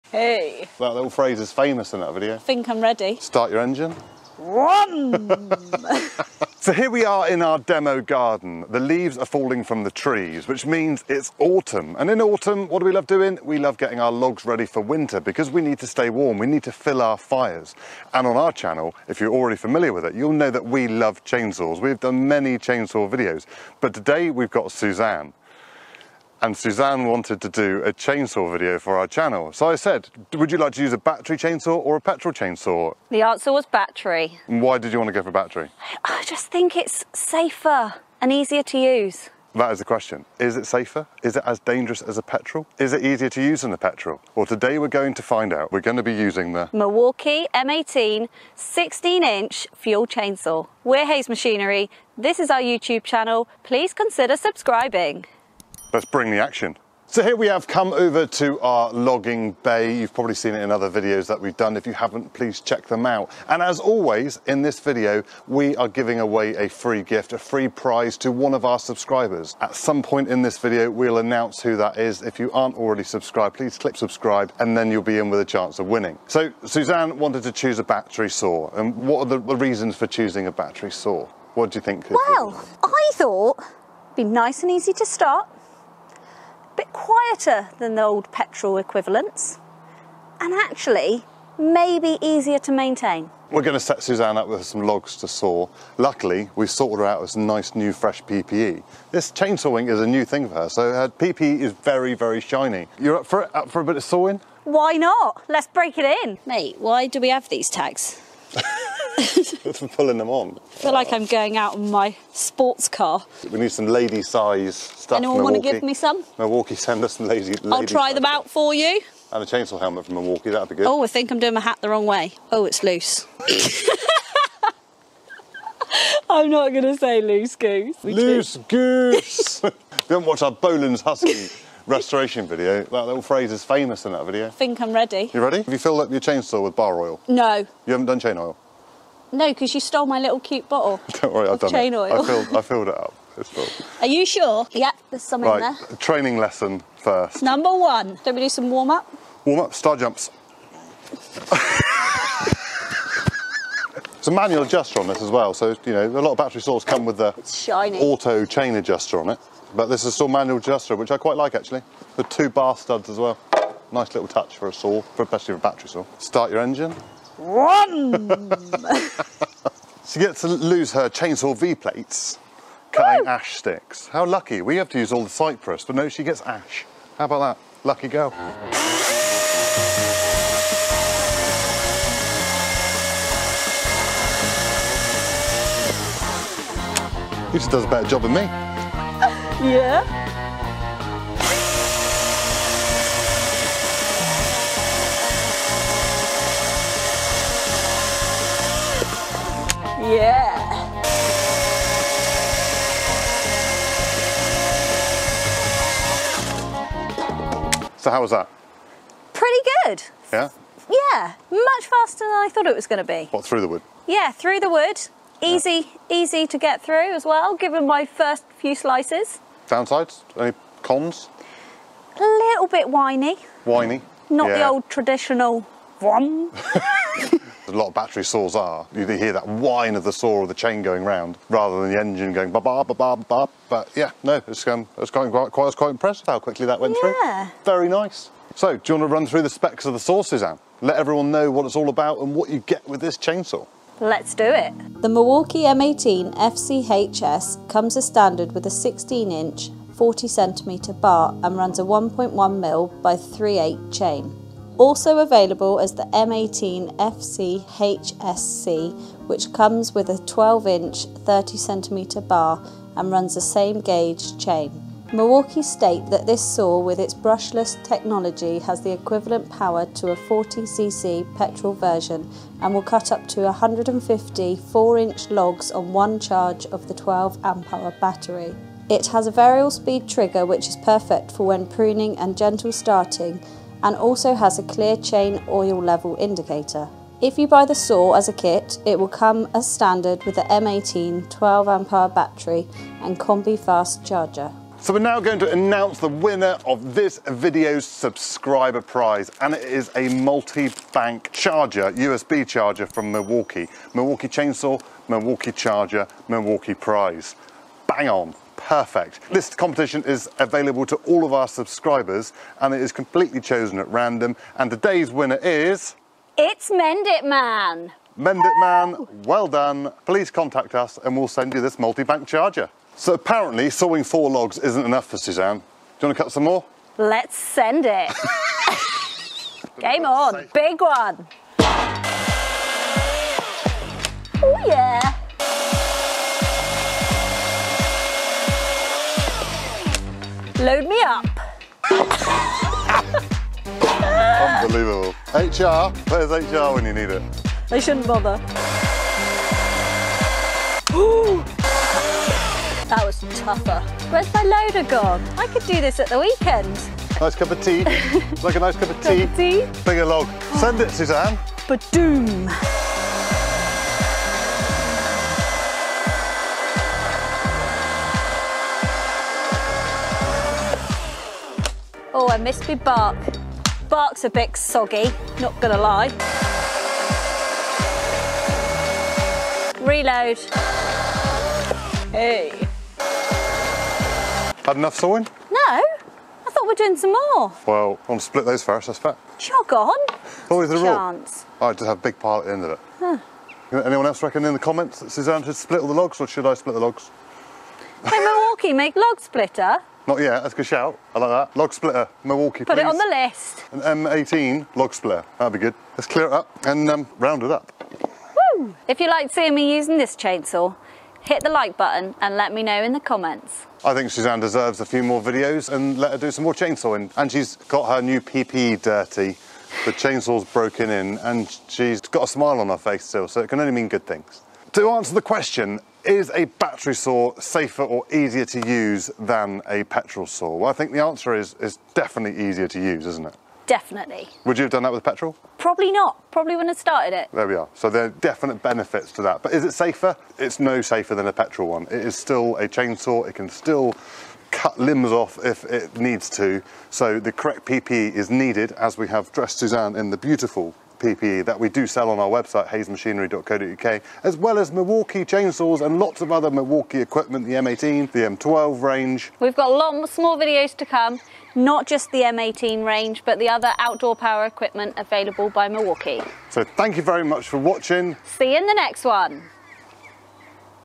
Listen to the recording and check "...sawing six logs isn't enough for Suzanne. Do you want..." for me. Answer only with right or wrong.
wrong.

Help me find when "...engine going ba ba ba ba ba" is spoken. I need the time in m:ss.
3:51.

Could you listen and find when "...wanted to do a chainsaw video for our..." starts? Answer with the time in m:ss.
0:27.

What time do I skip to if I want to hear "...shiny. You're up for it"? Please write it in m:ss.
1:42.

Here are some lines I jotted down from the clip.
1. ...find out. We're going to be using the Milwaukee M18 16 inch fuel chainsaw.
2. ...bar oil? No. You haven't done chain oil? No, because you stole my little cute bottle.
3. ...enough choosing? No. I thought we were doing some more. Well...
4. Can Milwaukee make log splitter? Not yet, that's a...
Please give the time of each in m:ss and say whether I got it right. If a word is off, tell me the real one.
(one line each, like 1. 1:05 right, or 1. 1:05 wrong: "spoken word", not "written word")
1. 0:45 right
2. 2:16 right
3. 6:24 wrong: "sawing", not "choosing"
4. 6:38 right.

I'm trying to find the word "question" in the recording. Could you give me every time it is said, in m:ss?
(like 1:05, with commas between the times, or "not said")
0:39, 7:05.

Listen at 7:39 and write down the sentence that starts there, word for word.
We've got lots more videos to come, not just the M18 range, but the other outdoor power equipment available by Milwaukee.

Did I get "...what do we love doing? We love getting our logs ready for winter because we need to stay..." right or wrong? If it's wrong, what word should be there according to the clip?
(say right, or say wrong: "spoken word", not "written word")
right.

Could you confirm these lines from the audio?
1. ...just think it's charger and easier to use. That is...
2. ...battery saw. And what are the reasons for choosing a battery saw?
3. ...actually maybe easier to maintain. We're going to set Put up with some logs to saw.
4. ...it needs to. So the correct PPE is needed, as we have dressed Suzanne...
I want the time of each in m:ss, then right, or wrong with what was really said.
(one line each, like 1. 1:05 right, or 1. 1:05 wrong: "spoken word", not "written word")
1. 0:36 wrong: "safer", not "charger"
2. 1:17 right
3. 1:30 wrong: "Suzanne", not "Put"
4. 7:25 right.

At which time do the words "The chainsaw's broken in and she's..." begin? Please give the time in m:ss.
6:59.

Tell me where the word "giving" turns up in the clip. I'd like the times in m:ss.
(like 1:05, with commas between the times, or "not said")
1:05.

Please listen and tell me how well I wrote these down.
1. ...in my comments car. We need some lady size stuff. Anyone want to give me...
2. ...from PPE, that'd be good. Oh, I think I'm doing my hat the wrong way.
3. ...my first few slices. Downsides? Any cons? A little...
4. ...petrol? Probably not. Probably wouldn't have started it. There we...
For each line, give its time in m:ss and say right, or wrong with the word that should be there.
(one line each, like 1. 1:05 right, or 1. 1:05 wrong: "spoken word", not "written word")
1. 1:51 wrong: "sports", not "comments"
2. 2:00 wrong: "Milwaukee", not "PPE"
3. 3:37 right
4. 7:15 right.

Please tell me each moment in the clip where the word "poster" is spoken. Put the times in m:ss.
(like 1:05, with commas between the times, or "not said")
not said.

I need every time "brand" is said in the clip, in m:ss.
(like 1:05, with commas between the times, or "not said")
not said.